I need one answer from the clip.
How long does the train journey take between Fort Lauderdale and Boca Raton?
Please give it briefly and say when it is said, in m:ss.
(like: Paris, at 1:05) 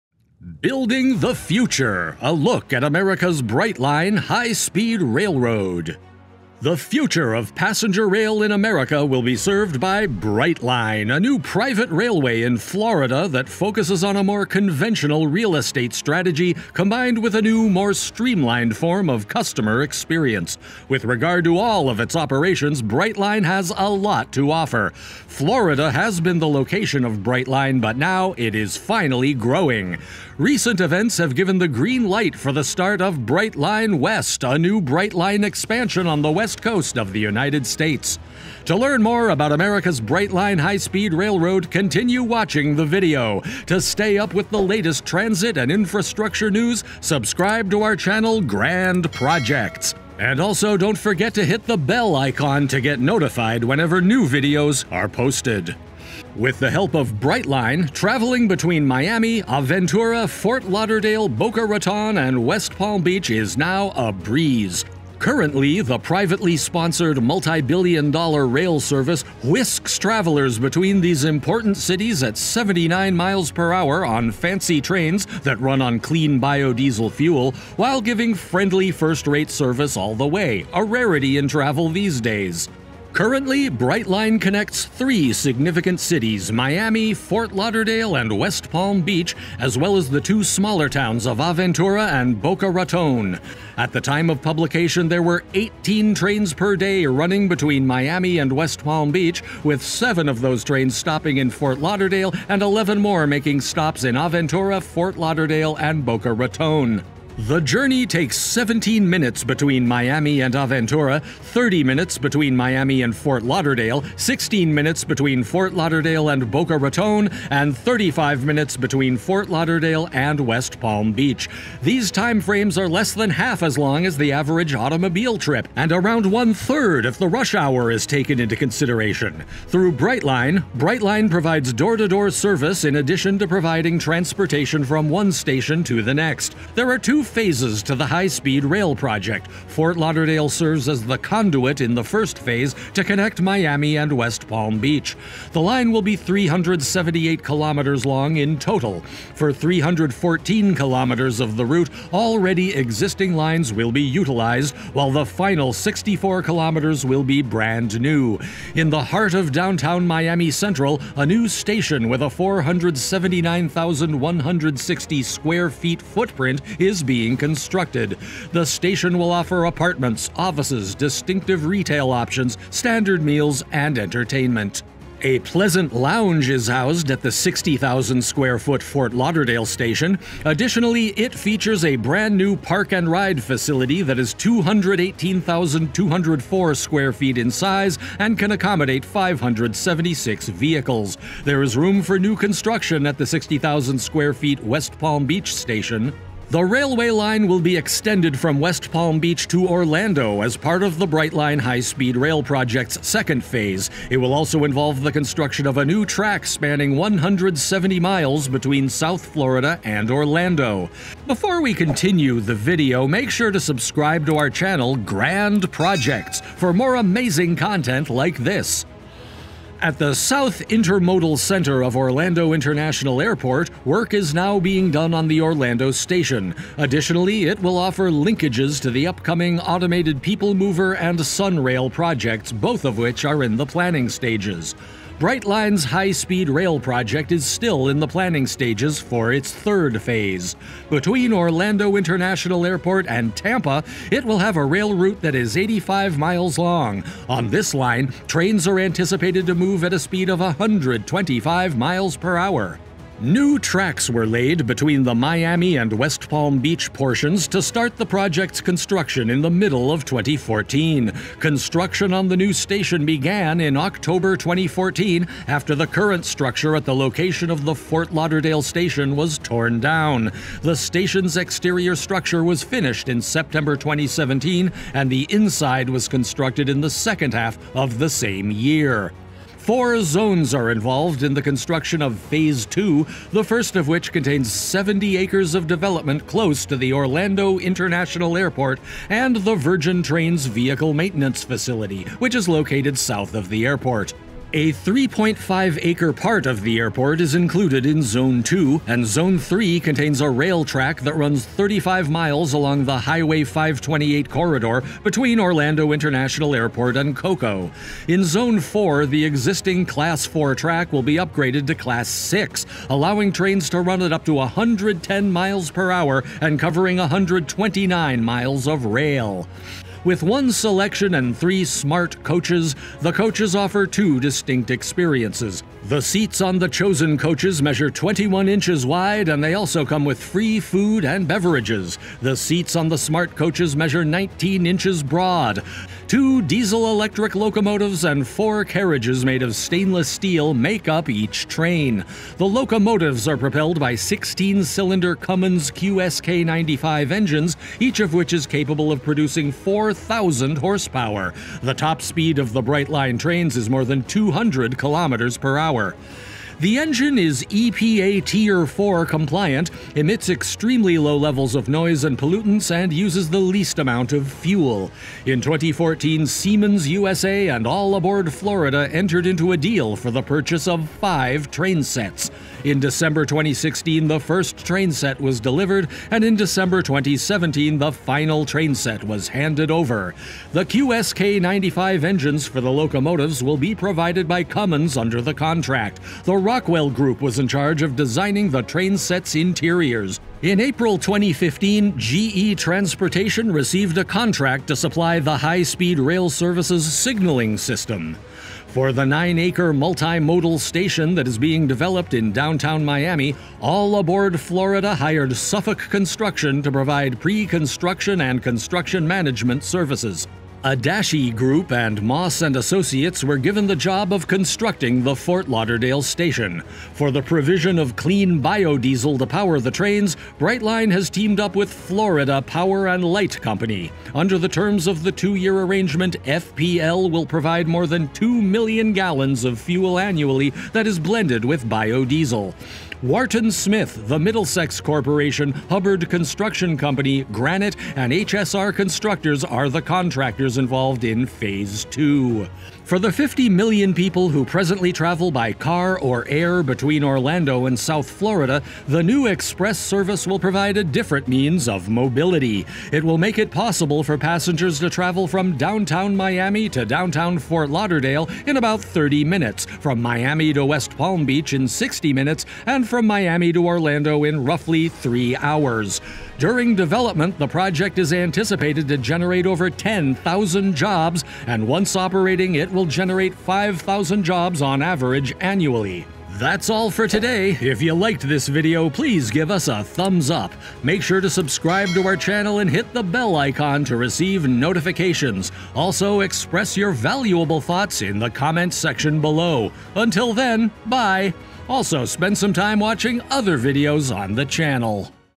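16 minutes, at 1:54.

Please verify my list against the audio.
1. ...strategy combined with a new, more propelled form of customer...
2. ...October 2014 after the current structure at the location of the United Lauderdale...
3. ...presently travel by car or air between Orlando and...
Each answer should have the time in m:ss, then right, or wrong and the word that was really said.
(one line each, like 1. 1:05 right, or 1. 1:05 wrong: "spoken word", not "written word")
1. 0:15 wrong: "streamlined", not "propelled"
2. 4:23 wrong: "Fort", not "United"
3. 7:24 right.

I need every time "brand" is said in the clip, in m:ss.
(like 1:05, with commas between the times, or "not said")
2:37, 3:01.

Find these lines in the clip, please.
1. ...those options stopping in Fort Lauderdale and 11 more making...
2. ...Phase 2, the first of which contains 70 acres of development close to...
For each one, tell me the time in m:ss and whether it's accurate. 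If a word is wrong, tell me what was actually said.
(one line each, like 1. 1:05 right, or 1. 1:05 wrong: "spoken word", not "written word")
1. 1:40 wrong: "trains", not "options"
2. 4:42 right.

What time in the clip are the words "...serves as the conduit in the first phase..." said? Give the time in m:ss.
2:20.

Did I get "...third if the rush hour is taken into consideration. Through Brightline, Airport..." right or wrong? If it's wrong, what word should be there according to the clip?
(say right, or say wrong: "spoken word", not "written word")
wrong: "Brightline", not "Airport".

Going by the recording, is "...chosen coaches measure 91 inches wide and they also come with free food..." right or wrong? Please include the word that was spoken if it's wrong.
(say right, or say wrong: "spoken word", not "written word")
wrong: "21", not "91".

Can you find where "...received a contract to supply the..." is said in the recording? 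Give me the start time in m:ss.
6:33.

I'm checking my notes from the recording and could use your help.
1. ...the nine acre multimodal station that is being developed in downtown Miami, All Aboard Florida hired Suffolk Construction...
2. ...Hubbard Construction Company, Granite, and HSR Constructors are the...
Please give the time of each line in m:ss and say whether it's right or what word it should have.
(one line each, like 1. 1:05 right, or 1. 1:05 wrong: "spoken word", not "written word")
1. 6:38 right
2. 7:15 right.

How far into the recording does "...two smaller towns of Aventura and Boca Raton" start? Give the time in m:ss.
1:30.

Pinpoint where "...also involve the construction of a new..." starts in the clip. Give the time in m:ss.
3:24.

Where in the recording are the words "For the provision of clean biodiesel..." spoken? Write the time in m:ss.
6:56.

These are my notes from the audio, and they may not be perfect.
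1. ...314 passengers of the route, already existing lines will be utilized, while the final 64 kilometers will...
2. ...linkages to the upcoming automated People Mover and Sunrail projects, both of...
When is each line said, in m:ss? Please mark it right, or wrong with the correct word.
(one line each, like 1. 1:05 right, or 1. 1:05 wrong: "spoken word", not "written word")
1. 2:29 wrong: "kilometers", not "passengers"
2. 3:48 right.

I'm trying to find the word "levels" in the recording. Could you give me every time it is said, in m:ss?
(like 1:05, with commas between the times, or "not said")
6:01.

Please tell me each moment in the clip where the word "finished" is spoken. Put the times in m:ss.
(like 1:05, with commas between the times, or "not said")
4:32.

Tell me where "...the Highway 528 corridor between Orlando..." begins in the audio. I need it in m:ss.
5:02.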